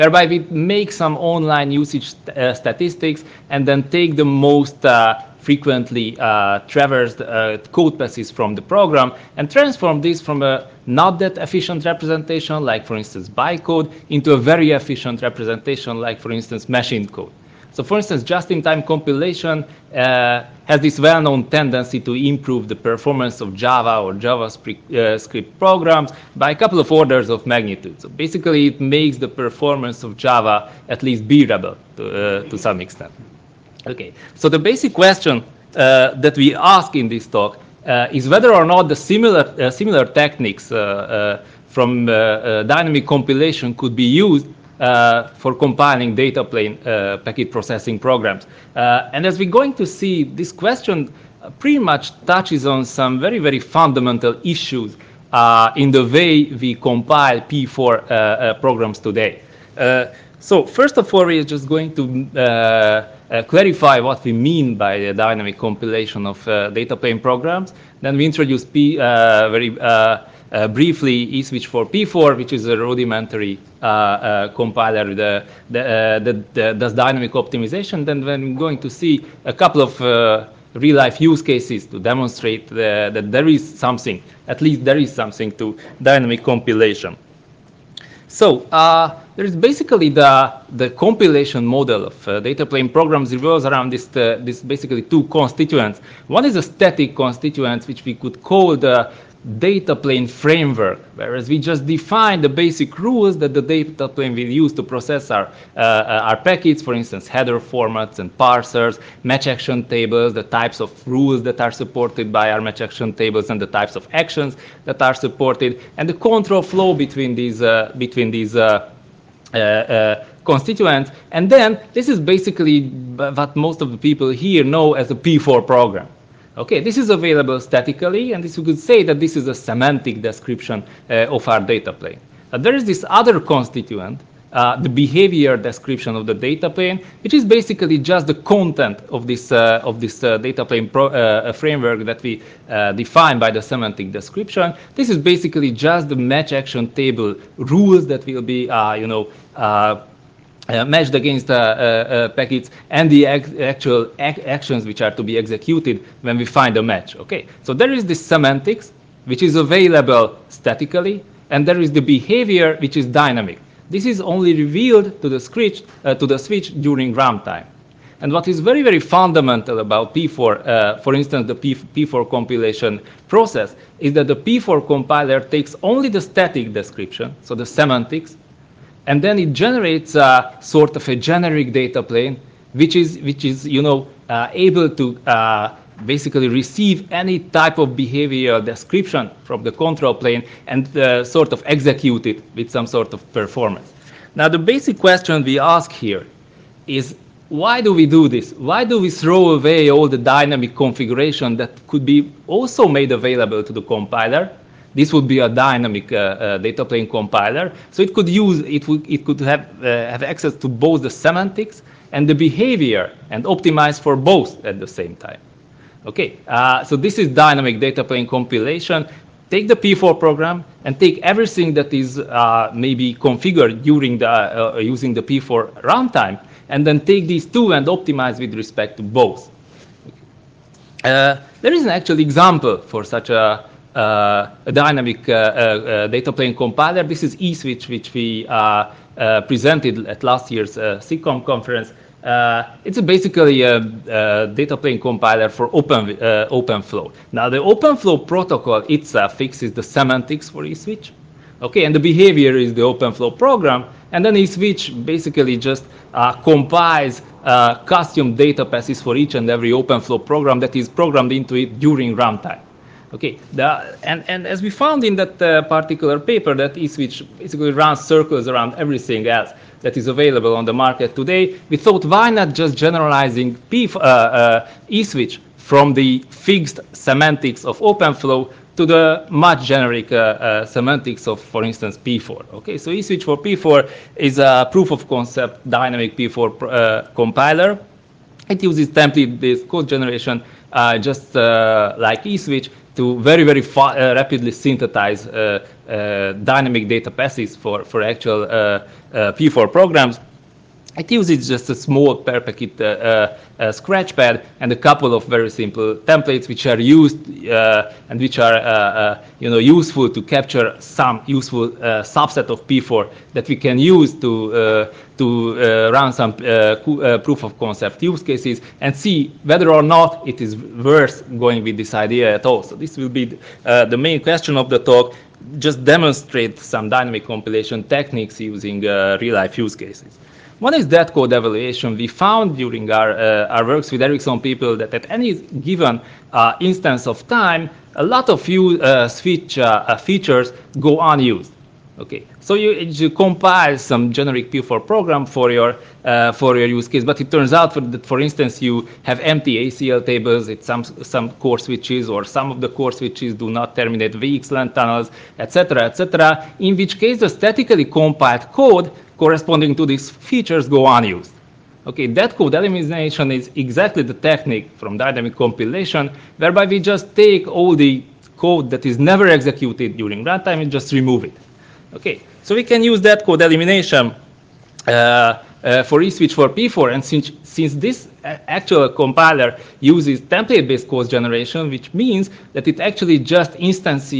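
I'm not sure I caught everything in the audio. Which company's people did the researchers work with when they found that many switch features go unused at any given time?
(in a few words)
Ericsson.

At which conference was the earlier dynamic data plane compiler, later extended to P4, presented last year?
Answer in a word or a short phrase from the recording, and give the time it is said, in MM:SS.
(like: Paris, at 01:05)
SIGCOMM, at 04:01.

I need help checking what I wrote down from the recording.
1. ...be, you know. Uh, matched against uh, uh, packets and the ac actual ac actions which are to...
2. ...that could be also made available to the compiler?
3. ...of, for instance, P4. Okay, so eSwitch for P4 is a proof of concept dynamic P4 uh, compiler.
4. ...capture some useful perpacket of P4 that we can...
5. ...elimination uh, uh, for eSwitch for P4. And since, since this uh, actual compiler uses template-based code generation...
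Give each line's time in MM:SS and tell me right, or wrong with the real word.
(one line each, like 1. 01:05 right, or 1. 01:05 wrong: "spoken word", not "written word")
1. 02:28 right
2. 03:21 right
3. 04:41 right
4. 05:10 wrong: "subset", not "perpacket"
5. 06:13 right.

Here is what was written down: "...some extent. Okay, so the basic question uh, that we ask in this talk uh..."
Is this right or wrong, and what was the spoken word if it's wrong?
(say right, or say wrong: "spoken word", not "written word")
right.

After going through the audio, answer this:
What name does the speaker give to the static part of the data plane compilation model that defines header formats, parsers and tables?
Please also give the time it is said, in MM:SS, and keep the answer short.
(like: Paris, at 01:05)
Data plane framework, at 01:39.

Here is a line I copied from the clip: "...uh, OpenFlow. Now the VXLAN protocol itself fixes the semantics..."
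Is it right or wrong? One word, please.
wrong.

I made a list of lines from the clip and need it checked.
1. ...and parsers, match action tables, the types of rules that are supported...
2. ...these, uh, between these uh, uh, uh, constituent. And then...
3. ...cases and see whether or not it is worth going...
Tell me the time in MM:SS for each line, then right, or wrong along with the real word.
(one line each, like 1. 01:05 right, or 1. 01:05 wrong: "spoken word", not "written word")
1. 01:48 right
2. 01:57 right
3. 05:18 right.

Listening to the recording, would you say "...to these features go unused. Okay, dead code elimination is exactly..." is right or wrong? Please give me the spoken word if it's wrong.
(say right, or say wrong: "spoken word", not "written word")
right.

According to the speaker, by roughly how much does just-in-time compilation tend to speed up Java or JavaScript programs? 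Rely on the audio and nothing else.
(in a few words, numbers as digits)
A couple of orders of magnitude.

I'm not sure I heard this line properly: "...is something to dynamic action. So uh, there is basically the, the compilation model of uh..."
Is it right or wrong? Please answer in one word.
wrong.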